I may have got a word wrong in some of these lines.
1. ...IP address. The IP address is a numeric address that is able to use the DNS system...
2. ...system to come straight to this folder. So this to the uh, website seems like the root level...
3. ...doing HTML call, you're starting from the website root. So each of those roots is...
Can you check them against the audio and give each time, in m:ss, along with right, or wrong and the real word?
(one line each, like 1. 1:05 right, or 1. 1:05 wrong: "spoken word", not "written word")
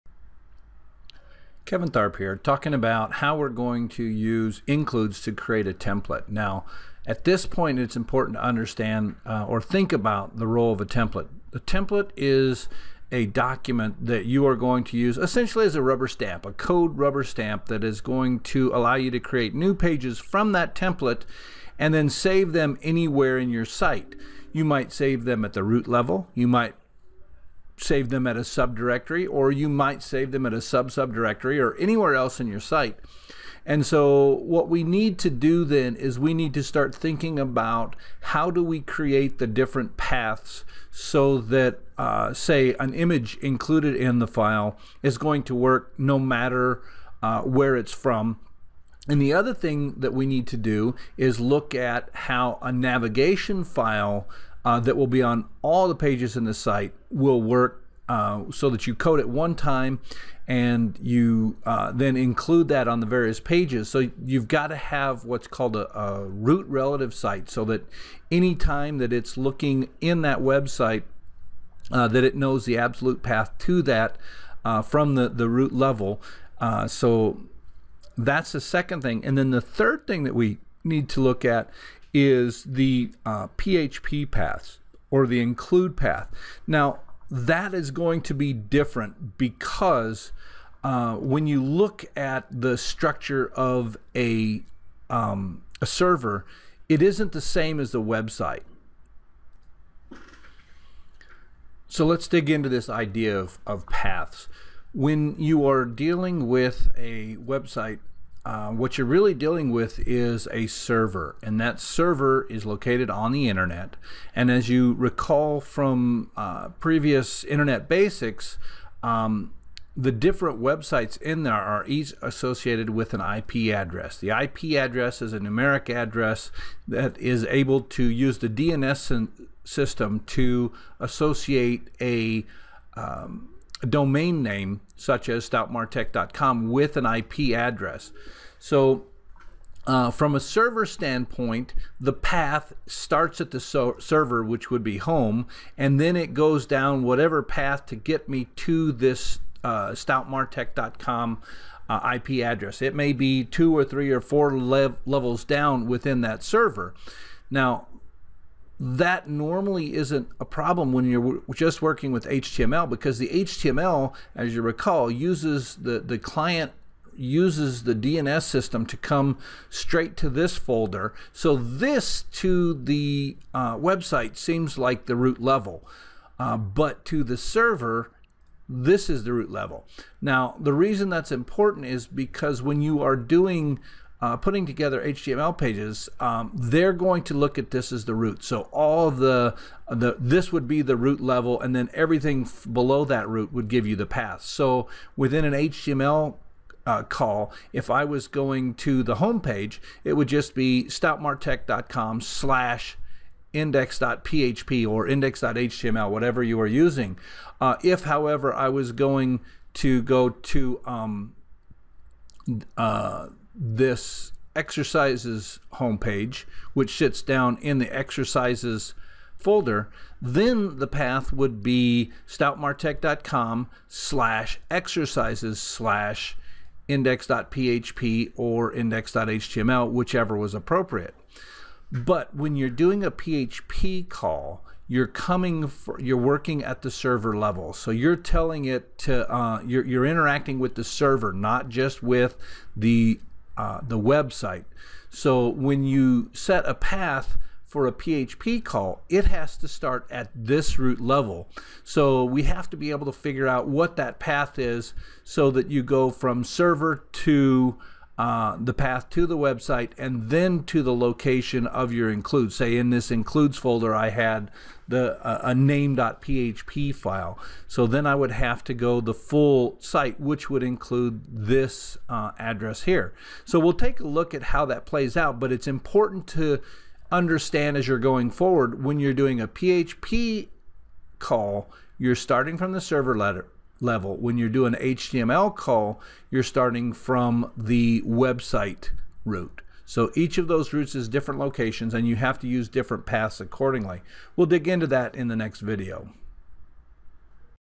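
1. 2:03 right
2. 2:48 right
3. 4:44 right.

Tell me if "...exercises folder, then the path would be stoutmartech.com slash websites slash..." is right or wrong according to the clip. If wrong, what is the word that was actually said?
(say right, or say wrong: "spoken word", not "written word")
wrong: "exercises", not "websites".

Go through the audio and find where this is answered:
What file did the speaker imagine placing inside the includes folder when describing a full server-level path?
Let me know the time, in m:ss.
4:25.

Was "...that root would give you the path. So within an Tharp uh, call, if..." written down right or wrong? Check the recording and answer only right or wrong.
wrong.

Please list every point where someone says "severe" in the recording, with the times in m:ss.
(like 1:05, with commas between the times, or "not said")
not said.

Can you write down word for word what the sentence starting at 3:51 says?
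But when you're doing a PHP call, you're coming, for, you're working at the server level.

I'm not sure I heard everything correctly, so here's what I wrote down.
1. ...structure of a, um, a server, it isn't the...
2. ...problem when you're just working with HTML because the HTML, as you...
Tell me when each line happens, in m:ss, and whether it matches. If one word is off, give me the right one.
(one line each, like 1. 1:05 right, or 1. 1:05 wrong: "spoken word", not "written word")
1. 1:32 right
2. 2:40 right.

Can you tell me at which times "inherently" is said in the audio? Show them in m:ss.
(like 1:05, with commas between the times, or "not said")
not said.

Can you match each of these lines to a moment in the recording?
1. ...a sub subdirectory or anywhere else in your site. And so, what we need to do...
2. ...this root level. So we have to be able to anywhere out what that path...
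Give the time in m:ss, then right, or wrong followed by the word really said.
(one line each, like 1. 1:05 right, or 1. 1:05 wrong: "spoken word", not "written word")
1. 0:30 right
2. 4:10 wrong: "figure", not "anywhere".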